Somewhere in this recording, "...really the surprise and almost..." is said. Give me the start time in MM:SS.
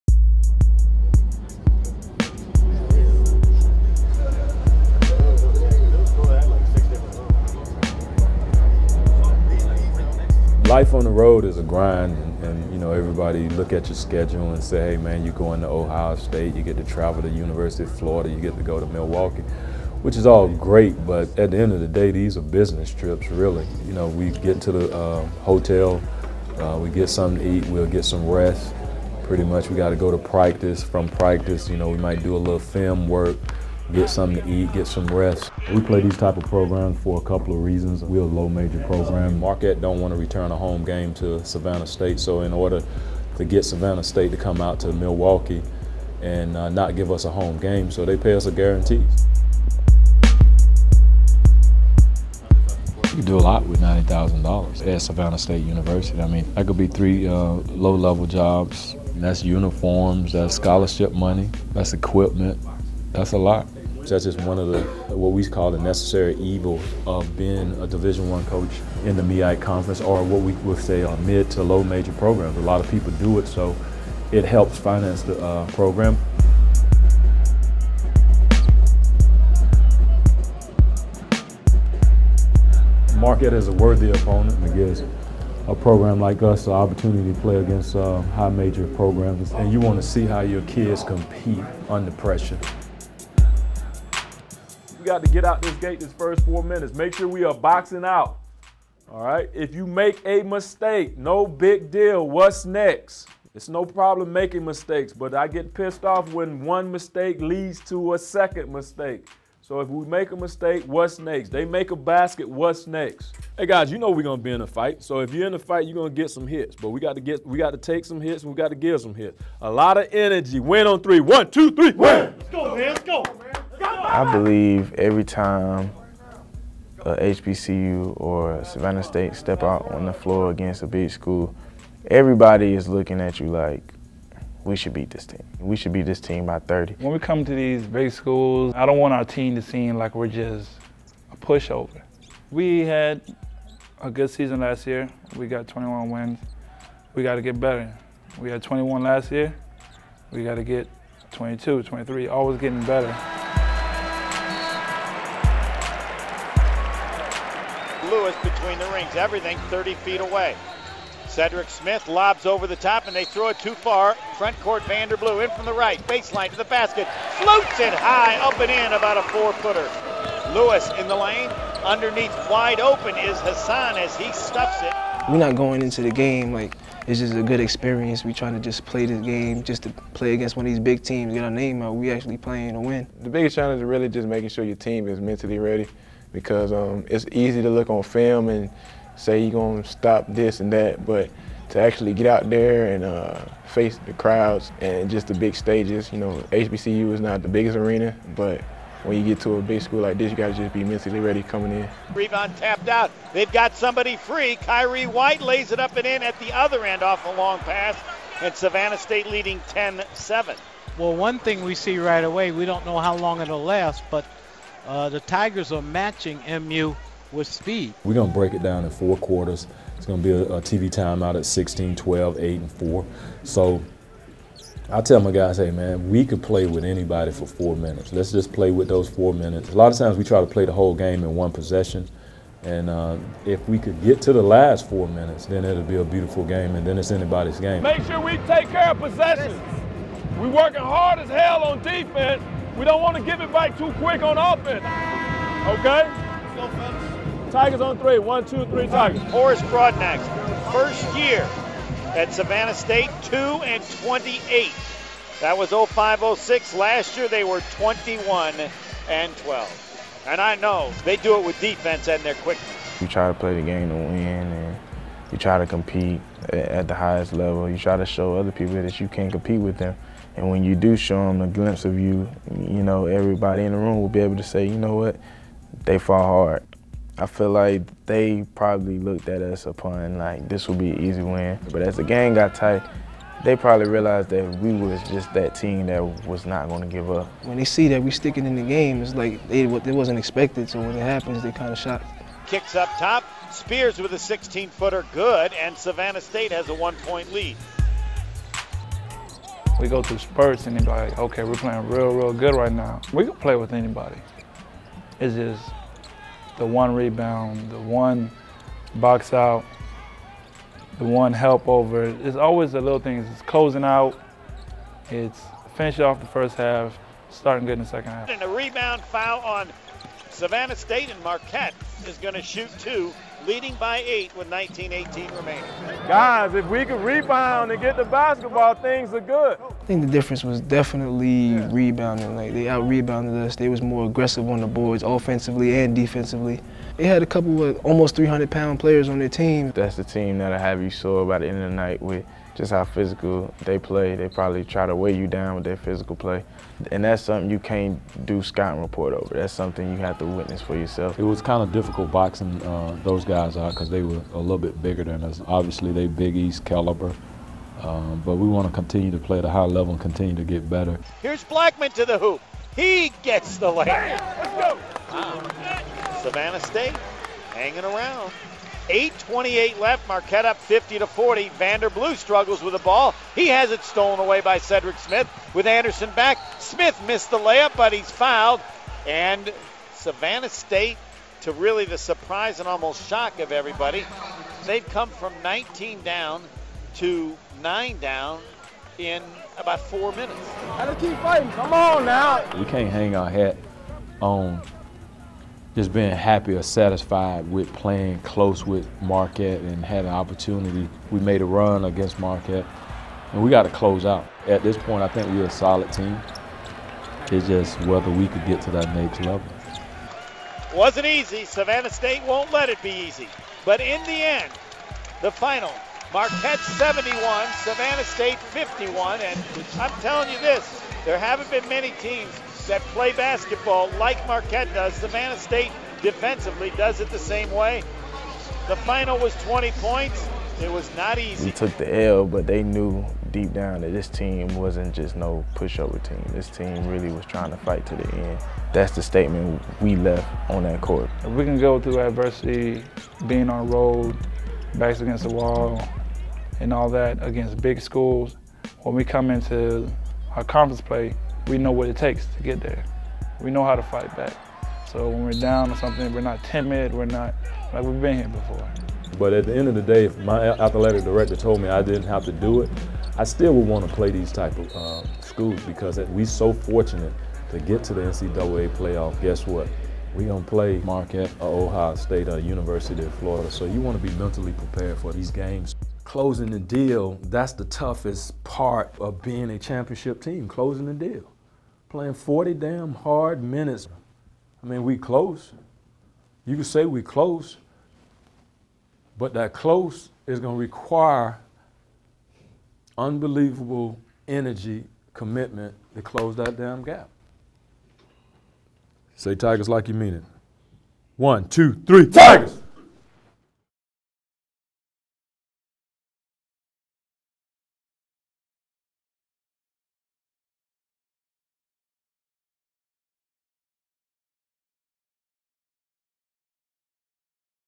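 06:21.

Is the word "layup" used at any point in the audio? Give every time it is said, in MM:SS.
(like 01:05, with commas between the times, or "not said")
06:03, 06:17.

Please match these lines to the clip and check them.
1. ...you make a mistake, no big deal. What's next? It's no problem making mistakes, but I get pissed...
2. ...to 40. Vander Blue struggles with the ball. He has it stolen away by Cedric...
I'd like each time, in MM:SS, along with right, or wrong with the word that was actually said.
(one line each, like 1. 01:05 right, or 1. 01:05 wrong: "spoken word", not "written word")
1. 01:39 right
2. 06:10 right.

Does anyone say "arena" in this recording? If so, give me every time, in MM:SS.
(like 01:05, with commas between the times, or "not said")
03:17.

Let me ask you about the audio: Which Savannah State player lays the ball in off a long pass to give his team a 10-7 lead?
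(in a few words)
Khiry White.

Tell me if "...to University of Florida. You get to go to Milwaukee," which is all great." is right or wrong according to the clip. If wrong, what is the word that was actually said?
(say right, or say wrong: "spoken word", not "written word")
right.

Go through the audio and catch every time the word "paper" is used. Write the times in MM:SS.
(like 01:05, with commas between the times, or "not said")
not said.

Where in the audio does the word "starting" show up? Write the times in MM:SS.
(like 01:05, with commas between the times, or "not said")
05:17.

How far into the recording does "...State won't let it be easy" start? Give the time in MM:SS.
06:51.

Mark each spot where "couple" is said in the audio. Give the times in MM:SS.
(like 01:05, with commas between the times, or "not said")
00:37, 05:37.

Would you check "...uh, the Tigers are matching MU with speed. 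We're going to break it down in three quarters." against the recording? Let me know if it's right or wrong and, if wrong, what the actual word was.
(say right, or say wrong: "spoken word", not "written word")
wrong: "four", not "three".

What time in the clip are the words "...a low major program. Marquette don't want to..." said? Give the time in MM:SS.
00:38.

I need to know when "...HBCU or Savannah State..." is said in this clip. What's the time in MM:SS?
02:07.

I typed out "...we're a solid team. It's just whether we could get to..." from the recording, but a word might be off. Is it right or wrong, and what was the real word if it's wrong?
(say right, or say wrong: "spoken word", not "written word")
right.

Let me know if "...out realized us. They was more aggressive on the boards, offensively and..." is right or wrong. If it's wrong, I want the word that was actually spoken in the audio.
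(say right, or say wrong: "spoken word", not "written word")
wrong: "rebounded", not "realized".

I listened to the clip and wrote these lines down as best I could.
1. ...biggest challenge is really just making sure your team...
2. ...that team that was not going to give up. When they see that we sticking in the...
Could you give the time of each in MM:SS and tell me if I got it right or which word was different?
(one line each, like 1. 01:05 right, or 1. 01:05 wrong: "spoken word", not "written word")
1. 03:03 right
2. 04:45 right.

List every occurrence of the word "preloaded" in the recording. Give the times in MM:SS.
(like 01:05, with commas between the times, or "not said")
not said.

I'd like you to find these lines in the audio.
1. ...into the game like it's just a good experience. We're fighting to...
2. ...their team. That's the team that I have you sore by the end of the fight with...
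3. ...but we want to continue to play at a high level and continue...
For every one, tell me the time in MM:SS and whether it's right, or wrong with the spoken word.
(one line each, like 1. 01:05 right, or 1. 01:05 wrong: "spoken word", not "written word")
1. 02:55 wrong: "trying", not "fighting"
2. 05:39 wrong: "night", not "fight"
3. 05:58 right.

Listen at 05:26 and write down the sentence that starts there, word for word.
Guys, if we could rebound and get the basketball, things are good.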